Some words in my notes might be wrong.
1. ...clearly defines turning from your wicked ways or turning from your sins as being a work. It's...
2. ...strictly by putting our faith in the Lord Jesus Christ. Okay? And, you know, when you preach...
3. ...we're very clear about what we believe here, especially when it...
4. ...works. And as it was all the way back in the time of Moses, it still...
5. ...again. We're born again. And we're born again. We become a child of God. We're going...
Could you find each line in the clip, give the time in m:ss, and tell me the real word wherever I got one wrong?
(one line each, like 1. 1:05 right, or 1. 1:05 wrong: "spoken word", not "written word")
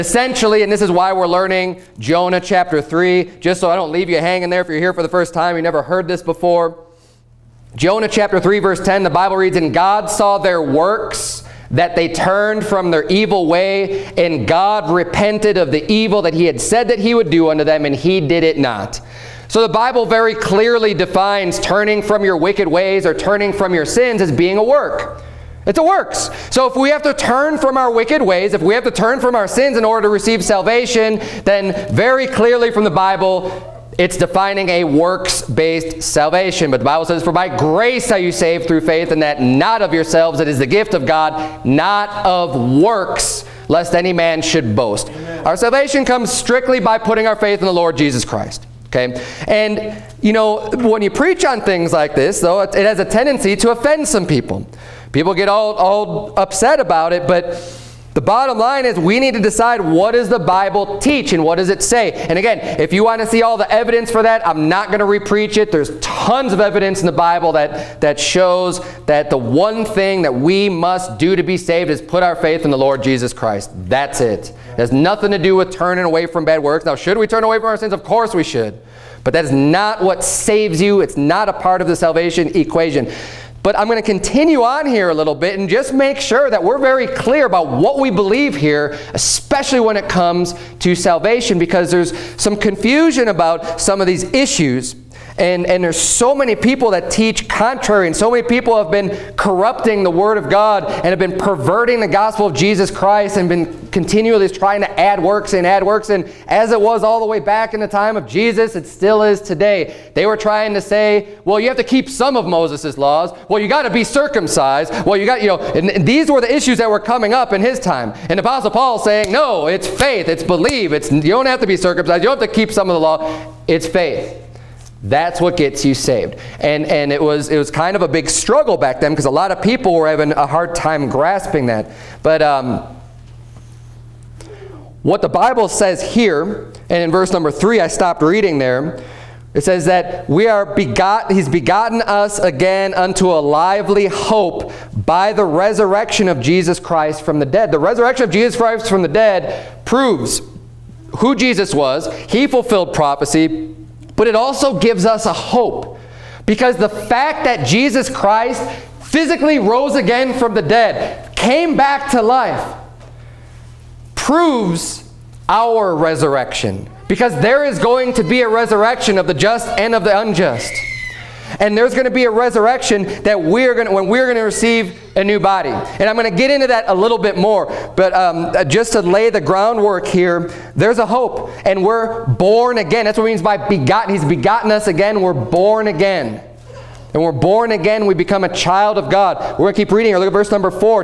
1. 0:20 right
2. 0:46 right
3. 1:26 right
4. 1:45 wrong: "Jesus", not "Moses"
5. 3:04 right.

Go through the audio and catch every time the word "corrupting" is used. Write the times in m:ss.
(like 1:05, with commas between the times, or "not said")
1:39.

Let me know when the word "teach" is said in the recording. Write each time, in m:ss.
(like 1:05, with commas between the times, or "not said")
1:00, 1:37.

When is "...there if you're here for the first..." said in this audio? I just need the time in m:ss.
0:04.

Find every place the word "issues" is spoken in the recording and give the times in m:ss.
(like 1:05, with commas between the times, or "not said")
1:34, 1:56.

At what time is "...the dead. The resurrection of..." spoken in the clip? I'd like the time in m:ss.
2:27.